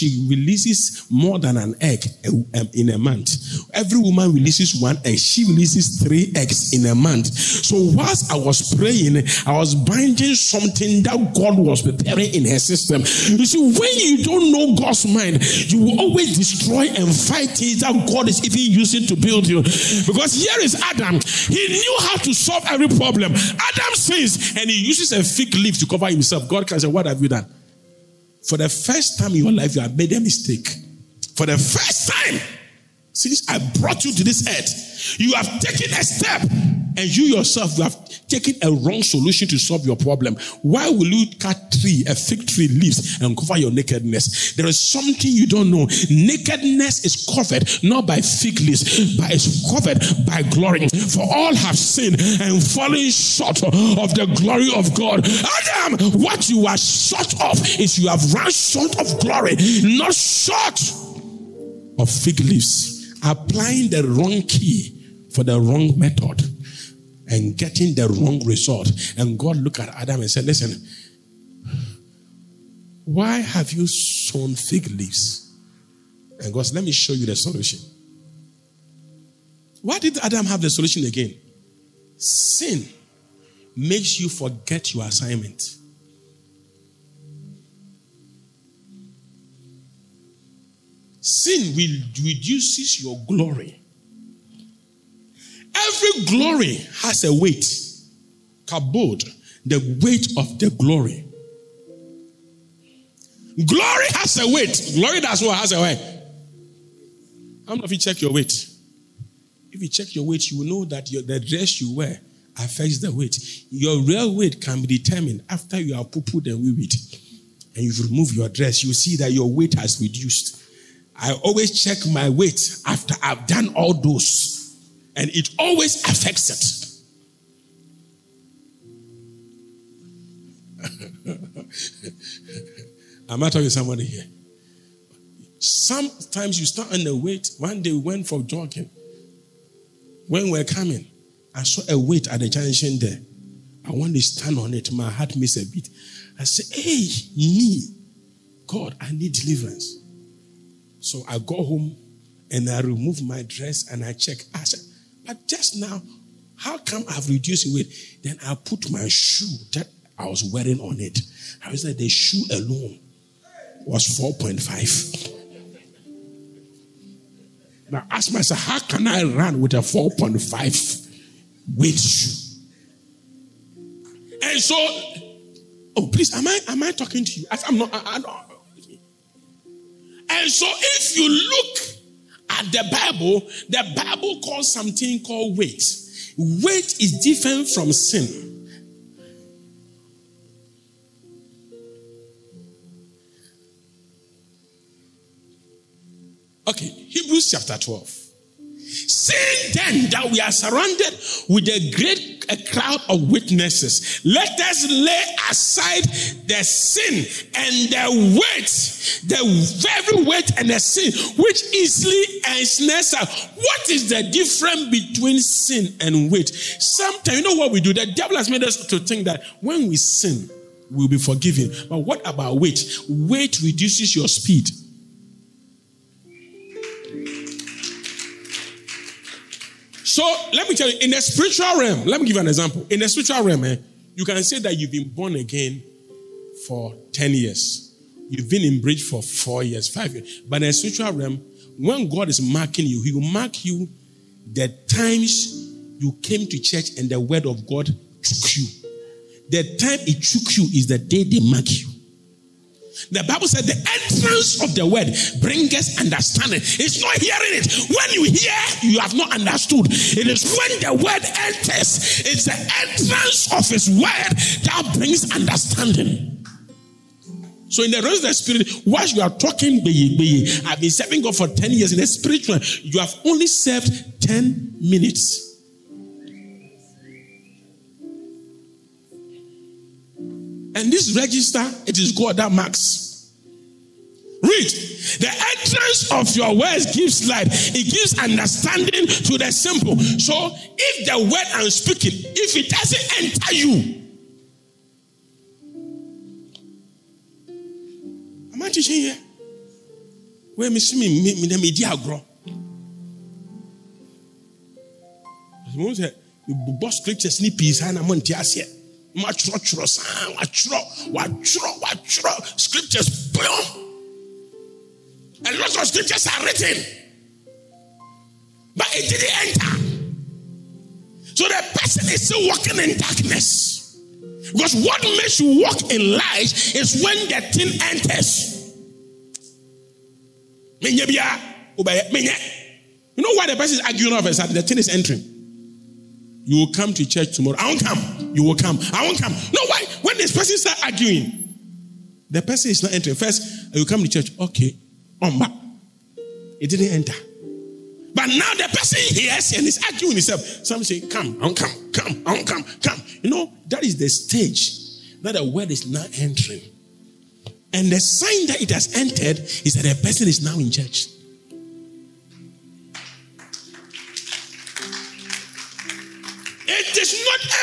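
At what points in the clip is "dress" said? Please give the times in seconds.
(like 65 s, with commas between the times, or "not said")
111 s, 118 s, 153 s.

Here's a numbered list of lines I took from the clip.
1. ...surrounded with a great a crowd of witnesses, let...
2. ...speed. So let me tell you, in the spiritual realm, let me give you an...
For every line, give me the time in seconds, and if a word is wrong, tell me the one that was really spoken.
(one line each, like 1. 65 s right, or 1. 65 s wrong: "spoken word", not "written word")
1. 200 s right
2. 224 s right.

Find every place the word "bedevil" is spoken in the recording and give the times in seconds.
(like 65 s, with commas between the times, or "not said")
not said.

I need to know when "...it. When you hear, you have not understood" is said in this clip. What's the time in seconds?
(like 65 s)
257 s.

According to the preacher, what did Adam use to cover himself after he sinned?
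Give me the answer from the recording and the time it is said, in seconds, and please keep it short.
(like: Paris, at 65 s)
fig leaf, at 25 s.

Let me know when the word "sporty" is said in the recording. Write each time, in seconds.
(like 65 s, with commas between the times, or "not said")
not said.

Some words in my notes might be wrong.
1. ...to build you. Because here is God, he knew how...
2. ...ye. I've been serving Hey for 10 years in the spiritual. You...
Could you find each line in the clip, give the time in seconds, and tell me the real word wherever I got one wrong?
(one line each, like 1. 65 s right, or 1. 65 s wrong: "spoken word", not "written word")
1. 19 s wrong: "Adam", not "God"
2. 270 s wrong: "God", not "Hey".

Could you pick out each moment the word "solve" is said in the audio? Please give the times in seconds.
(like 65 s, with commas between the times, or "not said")
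22 s, 39 s.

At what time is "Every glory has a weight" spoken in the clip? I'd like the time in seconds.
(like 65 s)
95 s.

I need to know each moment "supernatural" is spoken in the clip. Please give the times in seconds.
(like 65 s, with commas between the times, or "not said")
not said.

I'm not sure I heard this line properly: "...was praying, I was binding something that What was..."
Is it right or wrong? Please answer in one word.
wrong.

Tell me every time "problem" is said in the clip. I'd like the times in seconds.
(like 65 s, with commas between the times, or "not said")
22 s, 39 s.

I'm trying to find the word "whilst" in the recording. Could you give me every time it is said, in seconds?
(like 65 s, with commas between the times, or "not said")
7 s, 268 s.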